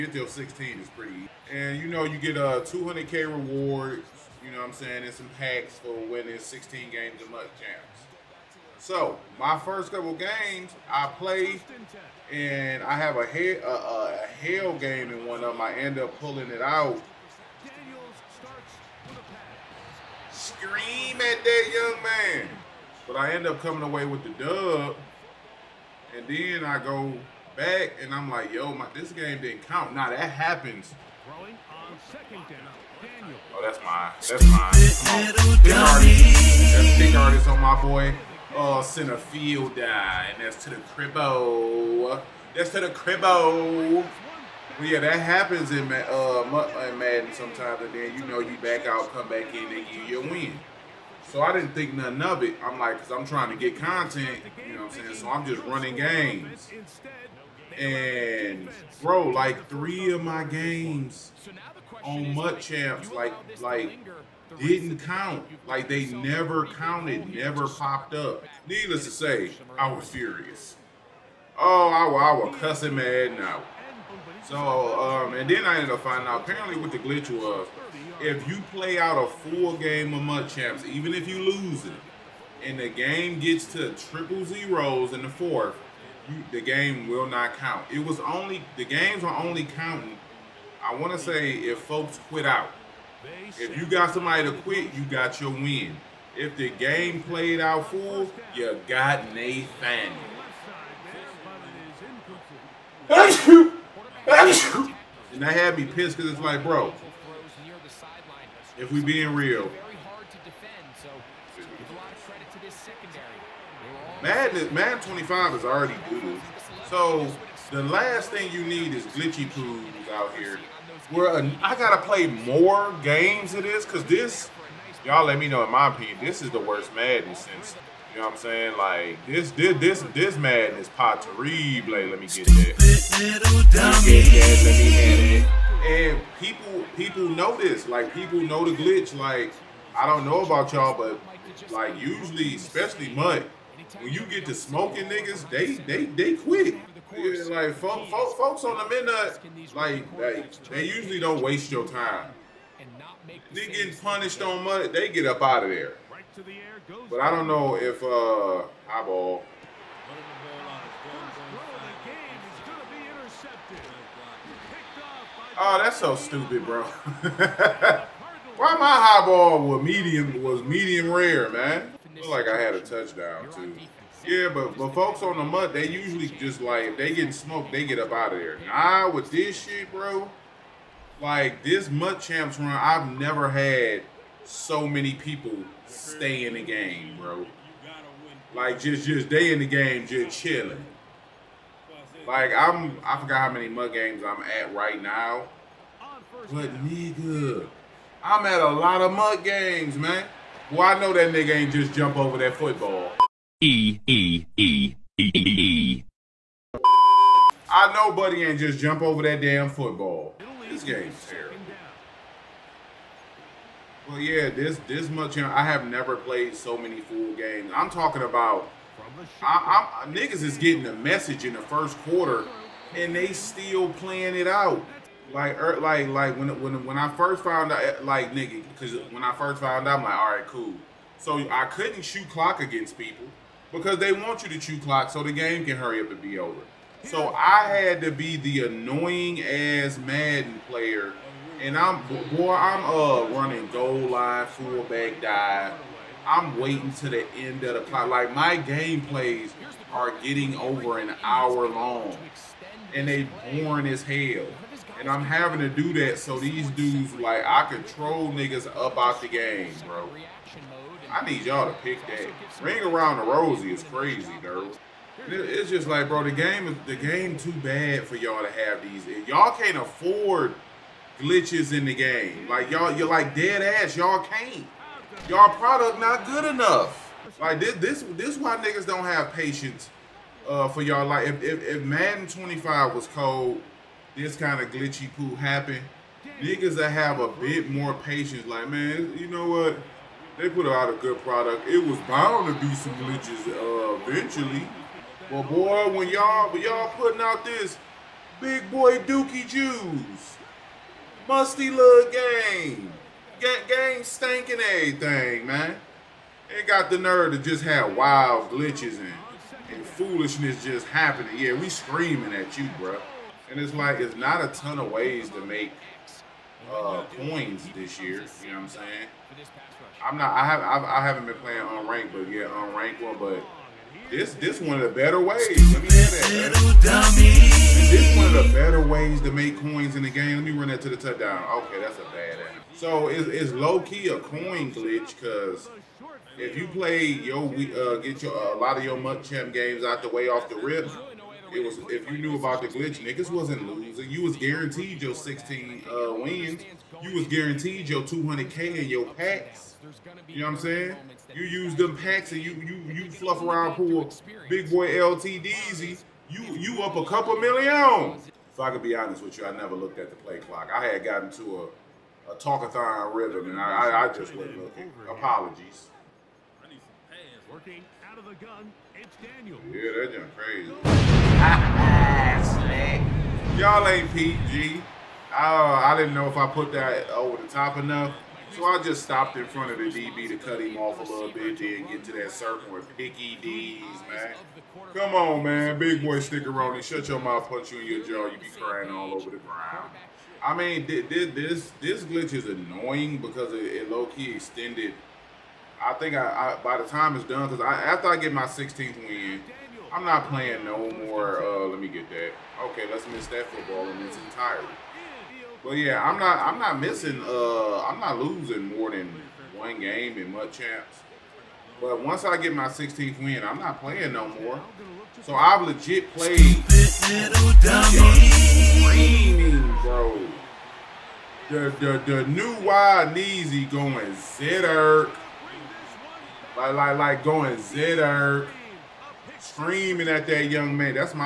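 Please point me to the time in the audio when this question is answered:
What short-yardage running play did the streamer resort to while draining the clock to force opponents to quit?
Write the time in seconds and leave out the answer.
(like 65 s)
244 s.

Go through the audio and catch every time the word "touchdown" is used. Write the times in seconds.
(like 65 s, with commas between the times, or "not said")
172 s, 330 s.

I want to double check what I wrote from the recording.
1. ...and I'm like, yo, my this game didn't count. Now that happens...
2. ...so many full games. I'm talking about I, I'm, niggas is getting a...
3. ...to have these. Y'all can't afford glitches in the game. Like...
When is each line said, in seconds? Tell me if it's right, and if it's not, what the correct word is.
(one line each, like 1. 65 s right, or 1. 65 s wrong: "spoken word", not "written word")
1. 28 s right
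2. 216 s right
3. 268 s right.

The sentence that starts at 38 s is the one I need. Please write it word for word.
Oh, center field die, and that's to the cribbo.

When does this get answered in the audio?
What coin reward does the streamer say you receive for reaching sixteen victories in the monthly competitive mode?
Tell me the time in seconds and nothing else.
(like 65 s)
2 s.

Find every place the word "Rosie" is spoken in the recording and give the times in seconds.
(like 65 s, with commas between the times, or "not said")
263 s.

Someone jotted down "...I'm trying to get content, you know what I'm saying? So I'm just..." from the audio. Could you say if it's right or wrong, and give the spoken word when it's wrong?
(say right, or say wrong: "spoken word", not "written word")
right.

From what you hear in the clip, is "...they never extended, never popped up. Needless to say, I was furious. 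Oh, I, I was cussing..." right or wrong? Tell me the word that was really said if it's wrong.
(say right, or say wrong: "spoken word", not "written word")
wrong: "counted", not "extended".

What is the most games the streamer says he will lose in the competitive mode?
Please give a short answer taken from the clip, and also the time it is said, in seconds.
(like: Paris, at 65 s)
1, at 409 s.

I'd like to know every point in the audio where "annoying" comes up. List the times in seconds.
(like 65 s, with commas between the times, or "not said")
238 s, 392 s.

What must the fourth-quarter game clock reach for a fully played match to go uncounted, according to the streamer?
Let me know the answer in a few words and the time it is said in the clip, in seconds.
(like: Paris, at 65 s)
triple zeros, at 83 s.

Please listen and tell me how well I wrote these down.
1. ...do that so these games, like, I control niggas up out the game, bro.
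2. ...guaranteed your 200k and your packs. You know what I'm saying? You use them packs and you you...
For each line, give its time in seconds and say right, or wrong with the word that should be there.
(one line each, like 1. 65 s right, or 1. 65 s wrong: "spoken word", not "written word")
1. 255 s wrong: "dudes", not "games"
2. 347 s right.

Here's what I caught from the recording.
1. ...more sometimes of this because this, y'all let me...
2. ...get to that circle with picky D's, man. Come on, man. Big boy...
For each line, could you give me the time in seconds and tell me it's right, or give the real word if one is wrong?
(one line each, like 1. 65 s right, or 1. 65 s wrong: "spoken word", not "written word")
1. 122 s wrong: "games", not "sometimes"
2. 381 s right.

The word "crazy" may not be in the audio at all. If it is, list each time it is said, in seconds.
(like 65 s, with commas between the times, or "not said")
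263 s, 372 s.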